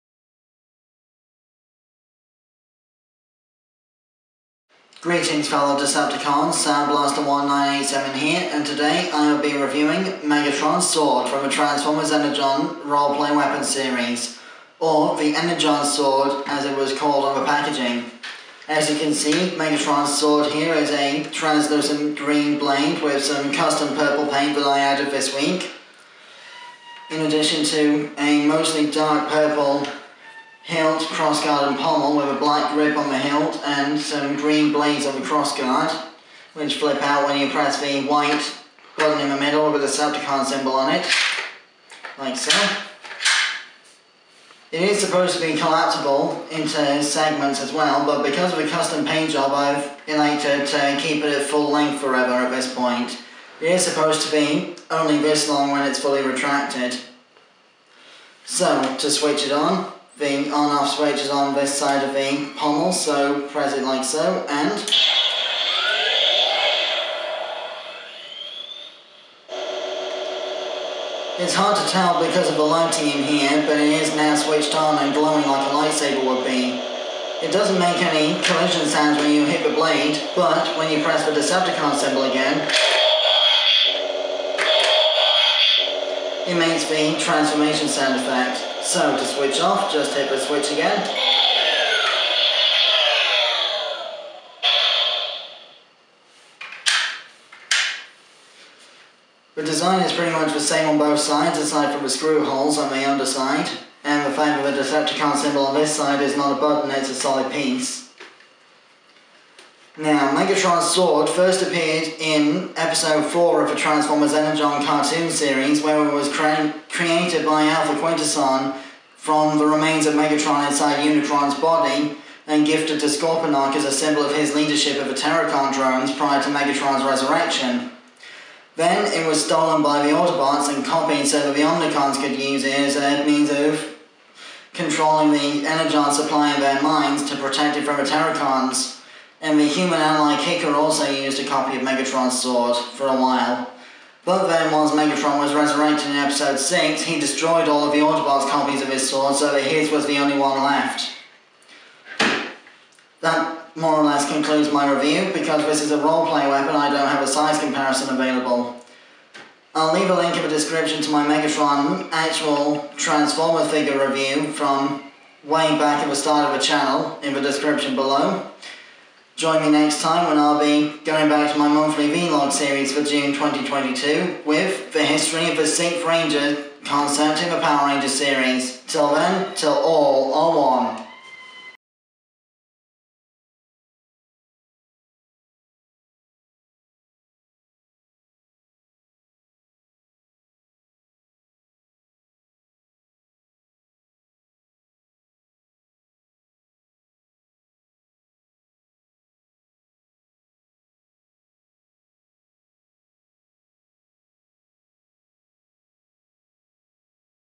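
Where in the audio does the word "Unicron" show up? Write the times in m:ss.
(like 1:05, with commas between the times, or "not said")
2:01.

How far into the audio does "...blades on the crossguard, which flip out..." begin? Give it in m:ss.
0:34.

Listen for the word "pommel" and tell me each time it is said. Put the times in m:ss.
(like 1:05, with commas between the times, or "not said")
0:31, 1:02.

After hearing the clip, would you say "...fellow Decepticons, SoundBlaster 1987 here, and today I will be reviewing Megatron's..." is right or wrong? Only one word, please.
right.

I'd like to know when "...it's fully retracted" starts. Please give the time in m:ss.
0:55.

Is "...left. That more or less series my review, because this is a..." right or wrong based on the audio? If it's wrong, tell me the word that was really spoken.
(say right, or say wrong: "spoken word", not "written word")
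wrong: "concludes", not "series".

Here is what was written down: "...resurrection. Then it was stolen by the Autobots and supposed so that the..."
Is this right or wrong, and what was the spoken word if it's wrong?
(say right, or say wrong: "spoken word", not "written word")
wrong: "copied", not "supposed".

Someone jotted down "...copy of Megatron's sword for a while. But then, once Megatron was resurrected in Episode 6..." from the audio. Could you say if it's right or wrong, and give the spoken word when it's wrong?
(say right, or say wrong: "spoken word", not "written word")
right.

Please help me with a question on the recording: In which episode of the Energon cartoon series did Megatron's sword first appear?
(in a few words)
4.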